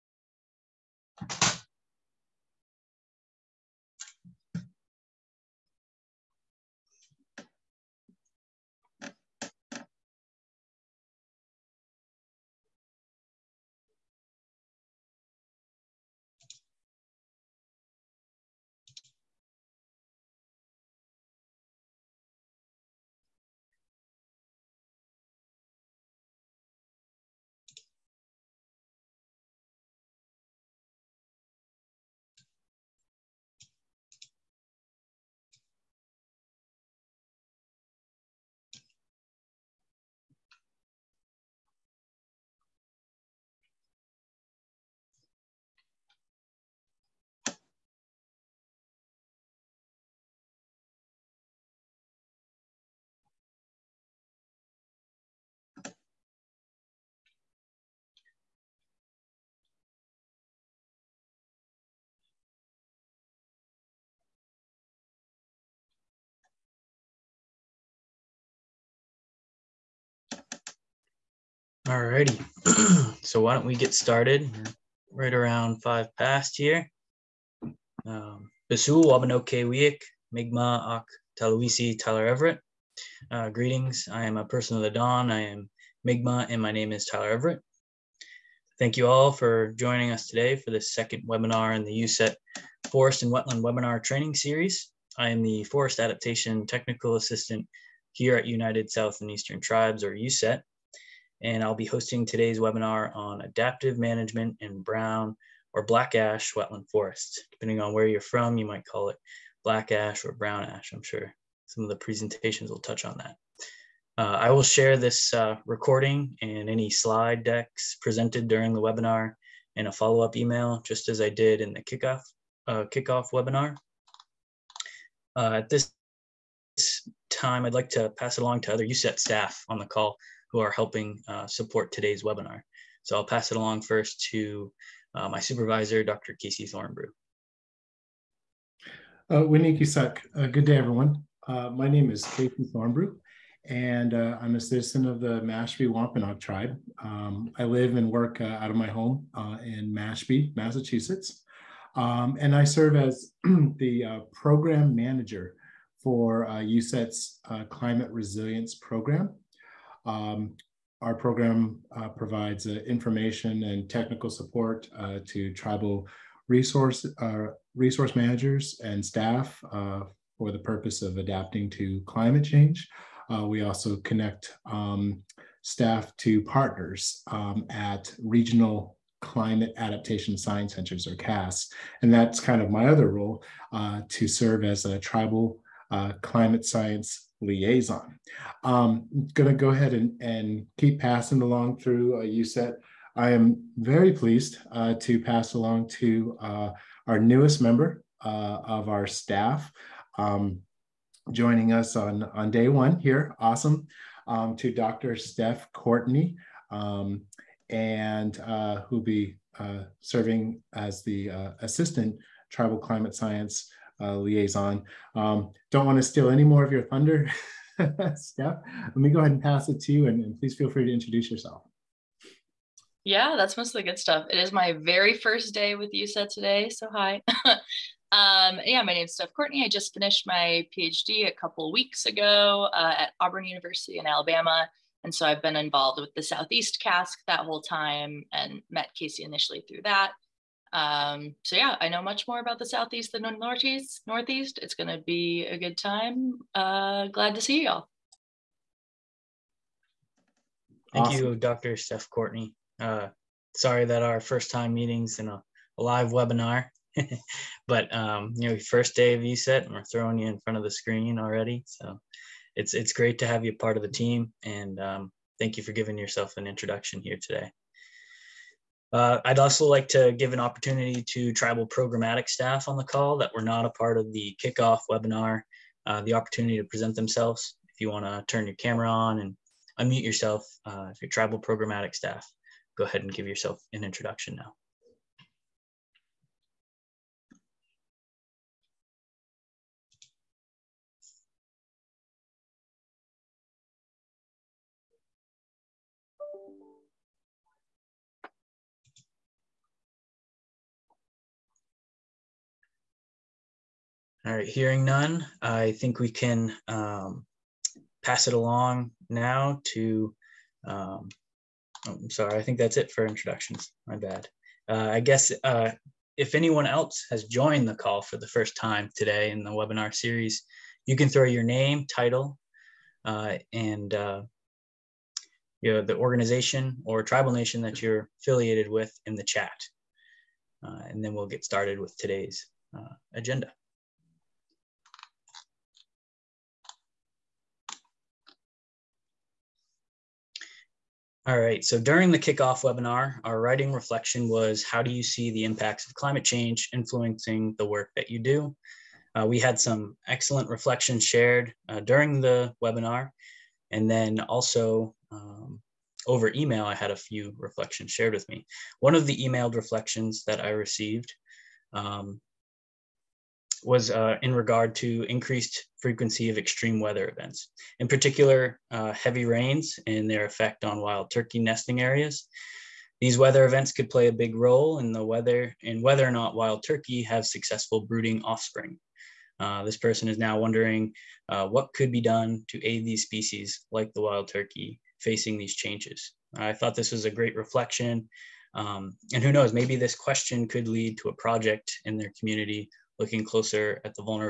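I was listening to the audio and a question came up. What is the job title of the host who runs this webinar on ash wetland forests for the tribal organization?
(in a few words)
Forest Adaptation Technical Assistant.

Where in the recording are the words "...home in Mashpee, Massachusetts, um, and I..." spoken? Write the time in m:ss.
2:28.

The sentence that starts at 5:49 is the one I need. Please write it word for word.
Uh, we had some excellent reflections shared uh, during the webinar.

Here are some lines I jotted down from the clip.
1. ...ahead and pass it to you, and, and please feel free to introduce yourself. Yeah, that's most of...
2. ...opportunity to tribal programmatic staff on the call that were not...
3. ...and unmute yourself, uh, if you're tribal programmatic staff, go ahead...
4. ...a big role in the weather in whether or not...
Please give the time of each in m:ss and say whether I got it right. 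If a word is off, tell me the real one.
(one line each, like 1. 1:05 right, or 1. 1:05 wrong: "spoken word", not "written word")
1. 3:39 right
2. 4:30 right
3. 4:39 right
4. 6:14 right.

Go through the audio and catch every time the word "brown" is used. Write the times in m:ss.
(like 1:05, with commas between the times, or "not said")
1:44, 1:50.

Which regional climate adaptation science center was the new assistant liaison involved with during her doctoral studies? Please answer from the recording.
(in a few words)
Southeast CASC.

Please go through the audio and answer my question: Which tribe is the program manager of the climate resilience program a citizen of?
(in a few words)
Mashpee Wampanoag.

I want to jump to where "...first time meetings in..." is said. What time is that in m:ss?
4:14.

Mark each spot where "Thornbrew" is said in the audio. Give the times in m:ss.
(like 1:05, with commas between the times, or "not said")
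2:16, 2:22.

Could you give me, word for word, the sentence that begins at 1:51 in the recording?
Some of the presentations will touch on that.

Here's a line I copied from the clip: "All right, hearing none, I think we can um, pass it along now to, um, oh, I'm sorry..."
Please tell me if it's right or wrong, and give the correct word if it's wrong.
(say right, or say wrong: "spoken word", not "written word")
right.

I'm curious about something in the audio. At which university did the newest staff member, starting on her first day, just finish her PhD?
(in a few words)
Auburn University.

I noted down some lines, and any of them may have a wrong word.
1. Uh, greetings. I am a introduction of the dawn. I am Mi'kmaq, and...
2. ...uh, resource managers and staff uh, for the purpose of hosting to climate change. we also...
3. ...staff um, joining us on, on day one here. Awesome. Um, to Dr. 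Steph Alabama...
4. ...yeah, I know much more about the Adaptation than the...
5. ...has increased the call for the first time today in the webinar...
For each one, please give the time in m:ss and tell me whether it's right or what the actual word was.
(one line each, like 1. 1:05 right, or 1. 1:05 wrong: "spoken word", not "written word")
1. 1:23 wrong: "person", not "introduction"
2. 2:47 wrong: "adapting", not "hosting"
3. 3:19 wrong: "Courtney", not "Alabama"
4. 4:01 wrong: "Southeast", not "Adaptation"
5. 5:17 wrong: "joined", not "increased".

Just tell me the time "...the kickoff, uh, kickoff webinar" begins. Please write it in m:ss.
2:01.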